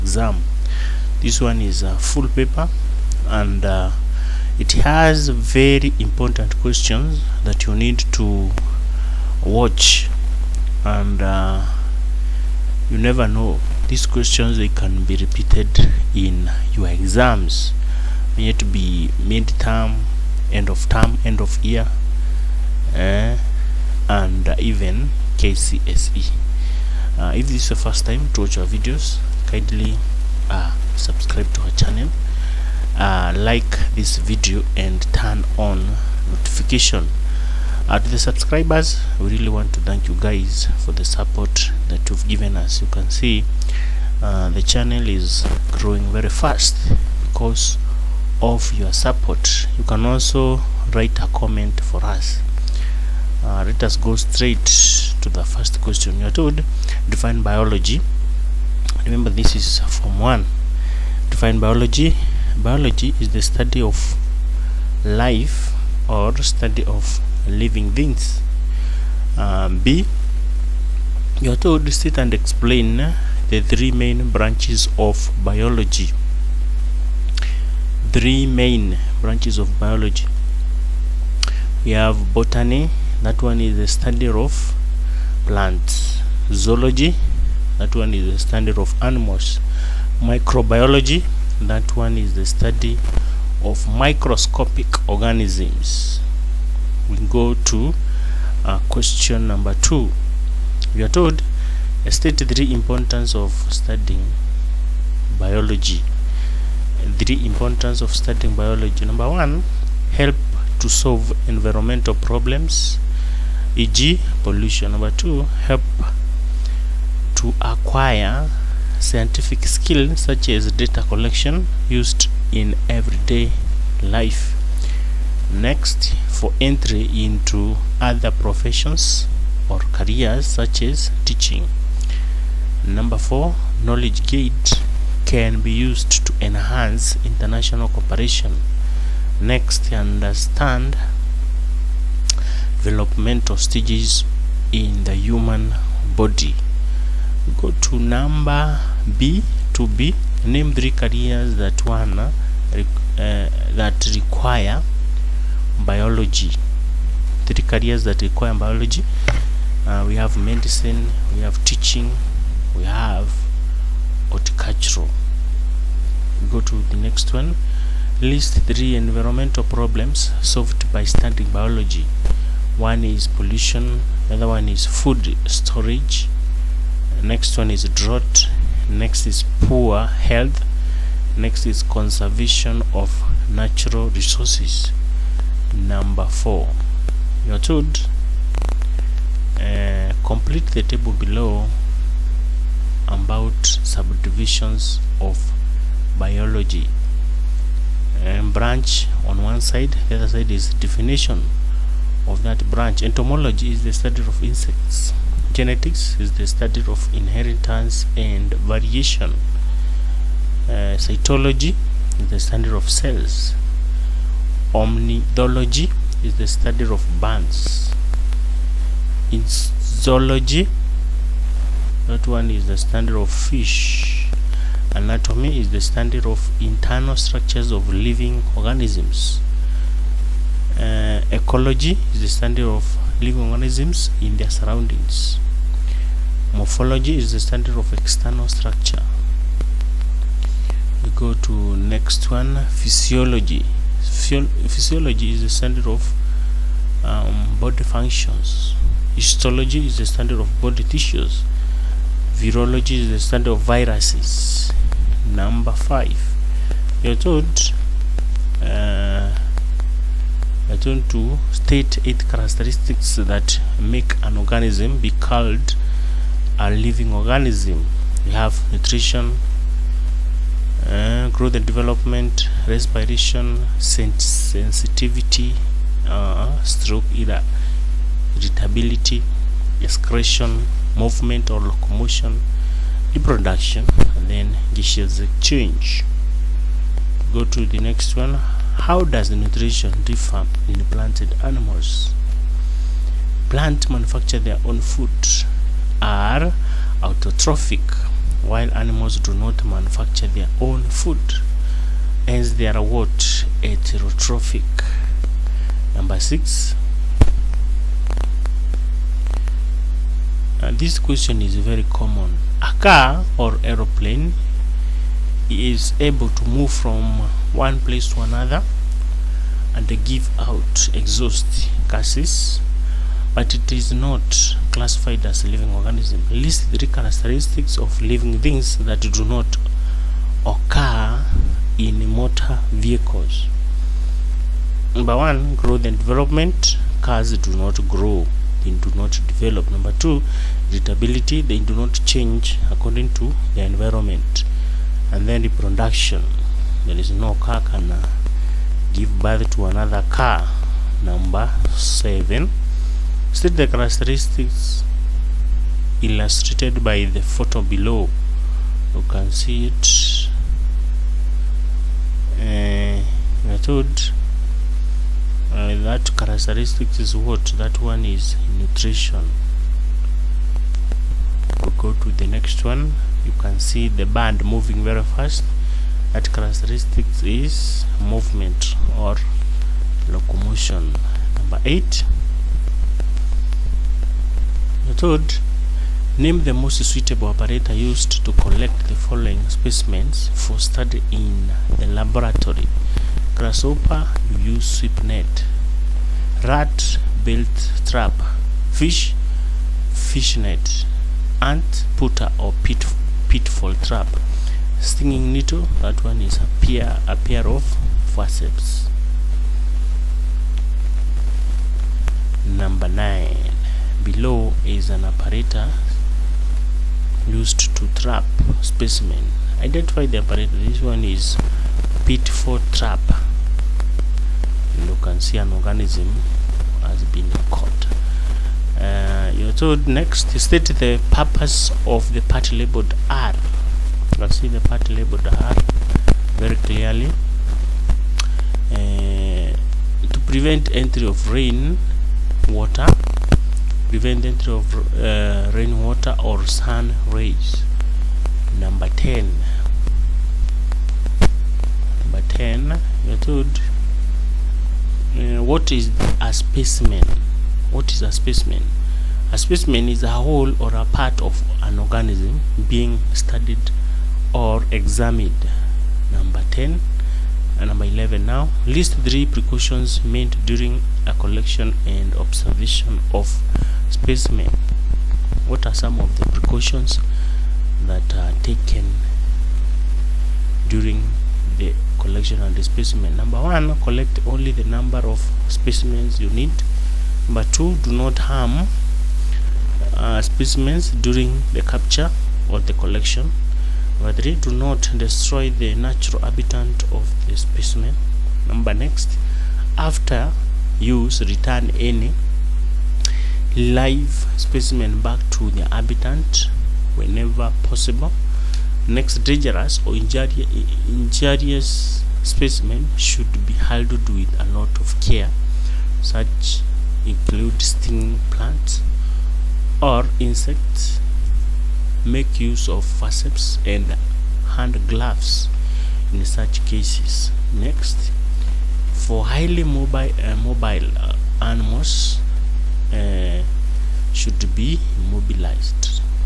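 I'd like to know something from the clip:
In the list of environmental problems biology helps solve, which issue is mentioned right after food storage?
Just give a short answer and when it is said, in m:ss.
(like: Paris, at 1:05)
Drought, at 2:57.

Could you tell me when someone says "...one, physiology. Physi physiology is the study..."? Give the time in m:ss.
4:02.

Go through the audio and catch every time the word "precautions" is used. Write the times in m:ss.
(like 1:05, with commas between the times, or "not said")
7:49, 7:56.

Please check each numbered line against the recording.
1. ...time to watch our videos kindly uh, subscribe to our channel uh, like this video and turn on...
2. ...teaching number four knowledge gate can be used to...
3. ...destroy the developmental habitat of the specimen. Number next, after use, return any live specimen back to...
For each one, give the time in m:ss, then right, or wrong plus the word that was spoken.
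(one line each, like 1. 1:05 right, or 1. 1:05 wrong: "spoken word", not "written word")
1. 0:28 right
2. 2:11 right
3. 8:14 wrong: "natural", not "developmental".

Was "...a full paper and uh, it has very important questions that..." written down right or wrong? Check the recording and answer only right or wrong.
right.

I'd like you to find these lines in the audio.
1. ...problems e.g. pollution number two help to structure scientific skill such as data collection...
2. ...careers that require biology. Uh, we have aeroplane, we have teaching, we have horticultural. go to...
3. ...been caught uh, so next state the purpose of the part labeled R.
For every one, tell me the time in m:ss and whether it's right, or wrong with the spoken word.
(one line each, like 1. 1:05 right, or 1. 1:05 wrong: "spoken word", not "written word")
1. 1:52 wrong: "acquire", not "structure"
2. 2:37 wrong: "medicine", not "aeroplane"
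3. 7:07 right.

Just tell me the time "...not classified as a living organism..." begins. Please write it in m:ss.
5:23.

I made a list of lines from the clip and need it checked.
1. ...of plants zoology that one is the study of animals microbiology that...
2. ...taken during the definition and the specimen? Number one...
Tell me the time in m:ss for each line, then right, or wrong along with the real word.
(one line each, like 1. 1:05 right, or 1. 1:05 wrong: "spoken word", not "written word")
1. 1:24 right
2. 7:58 wrong: "collection", not "definition".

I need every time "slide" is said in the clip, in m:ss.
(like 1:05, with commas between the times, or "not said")
not said.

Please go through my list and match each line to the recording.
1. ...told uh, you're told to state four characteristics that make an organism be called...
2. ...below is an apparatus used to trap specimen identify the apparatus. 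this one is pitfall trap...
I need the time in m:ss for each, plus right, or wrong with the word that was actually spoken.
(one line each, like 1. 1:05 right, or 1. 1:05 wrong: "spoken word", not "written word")
1. 4:17 wrong: "eight", not "four"
2. 6:54 right.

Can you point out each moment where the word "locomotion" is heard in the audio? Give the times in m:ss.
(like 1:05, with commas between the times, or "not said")
4:41, 6:20.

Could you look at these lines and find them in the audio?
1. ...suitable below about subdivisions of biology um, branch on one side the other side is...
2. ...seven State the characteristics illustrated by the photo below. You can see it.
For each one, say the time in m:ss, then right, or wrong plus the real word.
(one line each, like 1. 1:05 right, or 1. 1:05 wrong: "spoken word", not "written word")
1. 3:10 wrong: "table", not "suitable"
2. 5:51 right.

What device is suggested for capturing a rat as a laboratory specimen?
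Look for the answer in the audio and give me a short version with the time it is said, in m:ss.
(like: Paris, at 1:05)
Belt trap, at 6:37.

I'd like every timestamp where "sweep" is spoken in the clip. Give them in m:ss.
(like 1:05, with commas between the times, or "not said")
6:34.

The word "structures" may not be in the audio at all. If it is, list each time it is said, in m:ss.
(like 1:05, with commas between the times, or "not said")
3:47, 3:58.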